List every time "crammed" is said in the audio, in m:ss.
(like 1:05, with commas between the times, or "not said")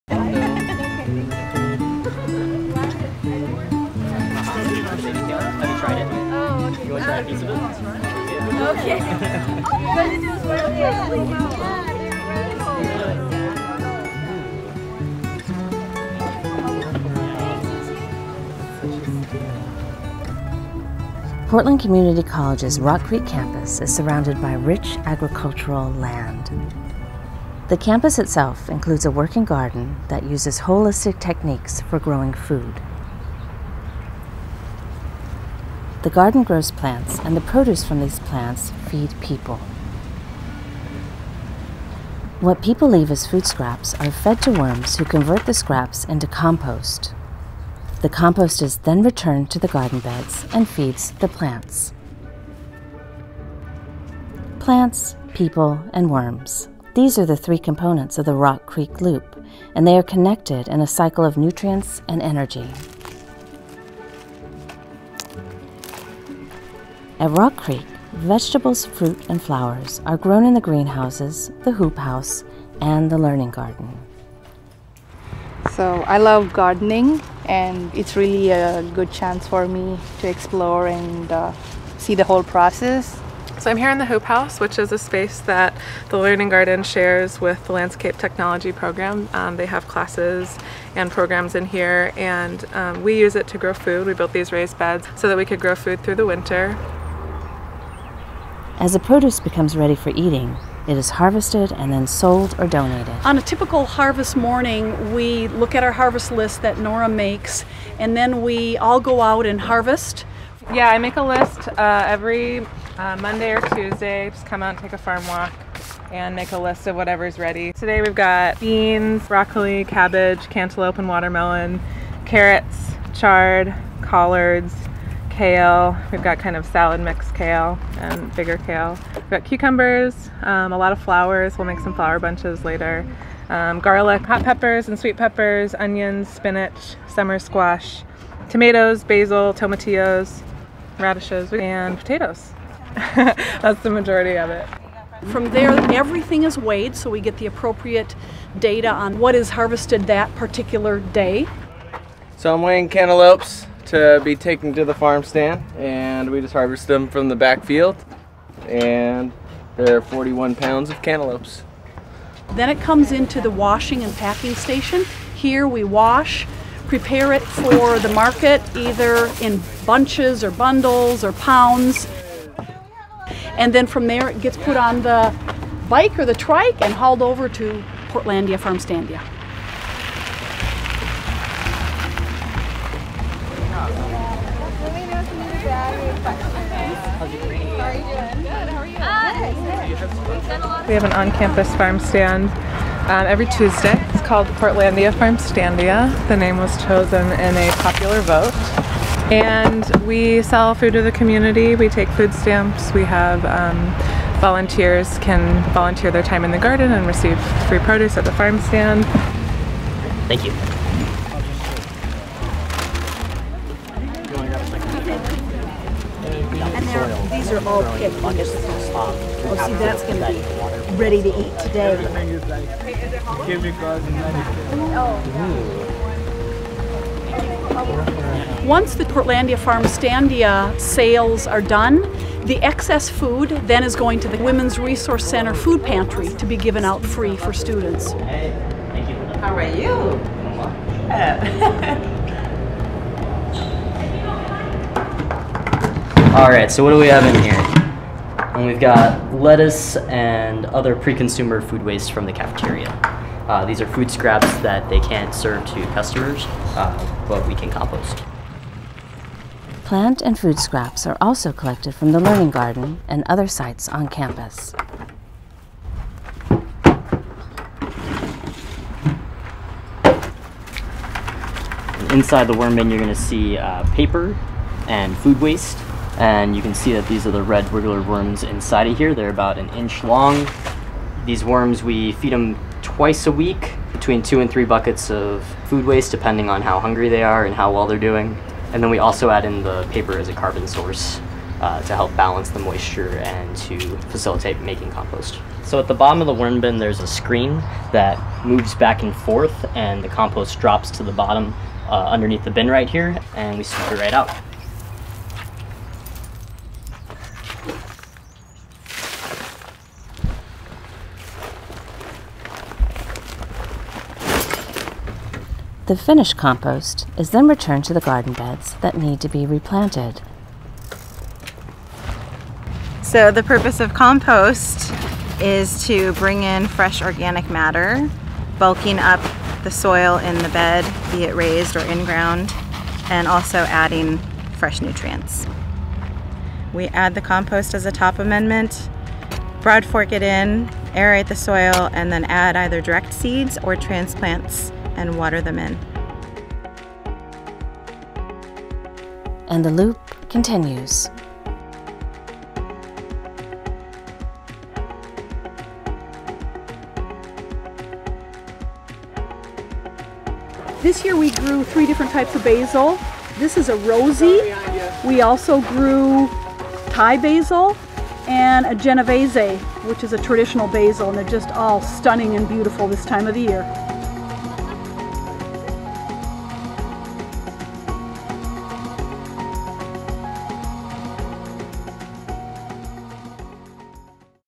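not said.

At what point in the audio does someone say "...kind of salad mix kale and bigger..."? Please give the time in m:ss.
2:06.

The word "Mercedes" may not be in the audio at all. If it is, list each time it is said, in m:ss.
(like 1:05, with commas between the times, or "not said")
not said.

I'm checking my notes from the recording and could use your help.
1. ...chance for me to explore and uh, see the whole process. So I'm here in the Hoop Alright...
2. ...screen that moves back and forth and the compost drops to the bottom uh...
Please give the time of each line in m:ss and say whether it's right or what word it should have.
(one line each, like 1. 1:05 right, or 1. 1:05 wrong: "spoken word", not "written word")
1. 1:19 wrong: "House", not "Alright"
2. 4:57 right.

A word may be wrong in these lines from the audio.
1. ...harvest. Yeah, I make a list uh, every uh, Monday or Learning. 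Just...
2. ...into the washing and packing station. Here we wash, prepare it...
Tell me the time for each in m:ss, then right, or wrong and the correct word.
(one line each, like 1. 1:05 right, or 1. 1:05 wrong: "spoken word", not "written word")
1. 1:49 wrong: "Tuesday", not "Learning"
2. 2:43 right.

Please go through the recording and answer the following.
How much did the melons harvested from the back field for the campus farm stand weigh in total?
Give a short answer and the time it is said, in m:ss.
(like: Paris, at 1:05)
41 pounds, at 2:40.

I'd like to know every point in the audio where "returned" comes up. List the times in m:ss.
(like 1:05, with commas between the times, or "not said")
0:49, 5:17.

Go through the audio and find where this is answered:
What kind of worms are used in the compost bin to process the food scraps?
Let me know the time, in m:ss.
4:37.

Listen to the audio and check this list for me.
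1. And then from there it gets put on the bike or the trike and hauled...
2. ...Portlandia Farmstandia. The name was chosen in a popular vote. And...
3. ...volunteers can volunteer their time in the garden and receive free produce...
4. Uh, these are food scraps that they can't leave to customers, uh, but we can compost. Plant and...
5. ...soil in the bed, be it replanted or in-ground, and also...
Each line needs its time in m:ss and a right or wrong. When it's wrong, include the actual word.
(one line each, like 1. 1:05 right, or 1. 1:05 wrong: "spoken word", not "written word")
1. 2:53 right
2. 3:14 right
3. 3:24 right
4. 4:13 wrong: "serve", not "leave"
5. 5:29 wrong: "raised", not "replanted".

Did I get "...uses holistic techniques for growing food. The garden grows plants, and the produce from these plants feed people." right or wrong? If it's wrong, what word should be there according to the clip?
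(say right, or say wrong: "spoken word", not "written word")
right.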